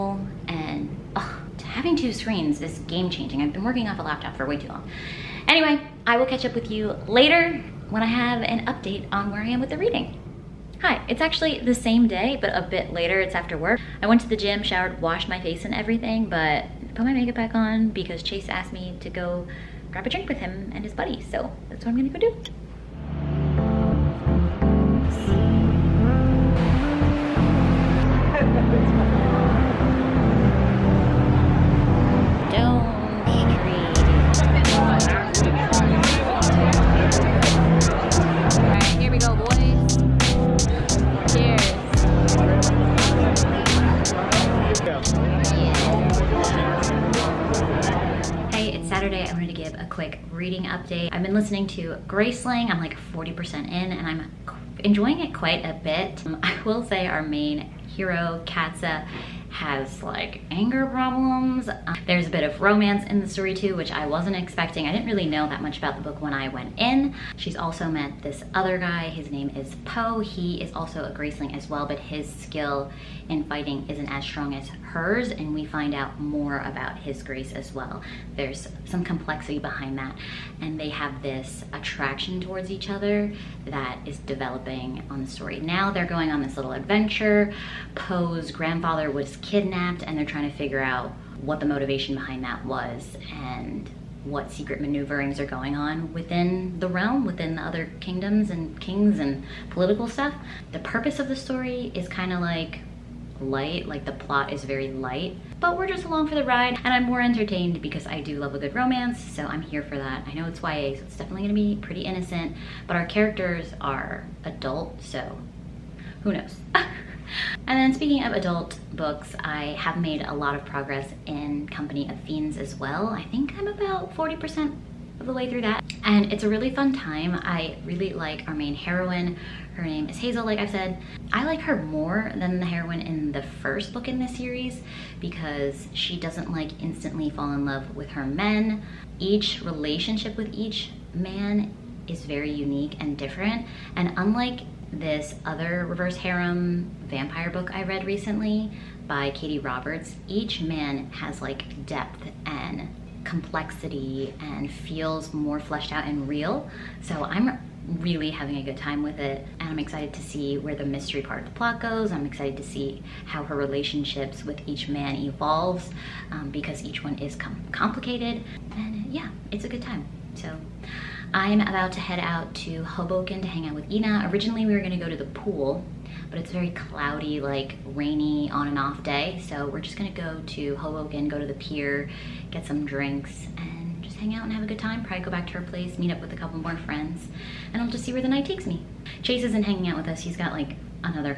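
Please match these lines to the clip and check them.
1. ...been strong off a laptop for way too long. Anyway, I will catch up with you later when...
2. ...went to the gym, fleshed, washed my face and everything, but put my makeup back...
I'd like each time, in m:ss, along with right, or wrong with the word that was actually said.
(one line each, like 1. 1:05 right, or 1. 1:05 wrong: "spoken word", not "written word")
1. 0:03 wrong: "working", not "strong"
2. 0:14 wrong: "showered", not "fleshed".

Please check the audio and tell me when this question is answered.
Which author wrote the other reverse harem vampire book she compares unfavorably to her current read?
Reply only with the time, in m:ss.
2:29.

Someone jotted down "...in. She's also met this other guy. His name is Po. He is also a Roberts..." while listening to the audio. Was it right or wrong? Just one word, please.
wrong.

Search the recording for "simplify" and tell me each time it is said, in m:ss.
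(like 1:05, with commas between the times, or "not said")
not said.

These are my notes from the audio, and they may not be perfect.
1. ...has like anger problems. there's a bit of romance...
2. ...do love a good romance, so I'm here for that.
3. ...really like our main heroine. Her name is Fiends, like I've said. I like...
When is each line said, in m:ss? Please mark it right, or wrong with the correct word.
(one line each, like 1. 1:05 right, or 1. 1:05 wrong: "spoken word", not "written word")
1. 0:59 right
2. 1:48 right
3. 2:07 wrong: "Hazel", not "Fiends".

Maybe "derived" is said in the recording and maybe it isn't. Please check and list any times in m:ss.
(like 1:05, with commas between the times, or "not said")
not said.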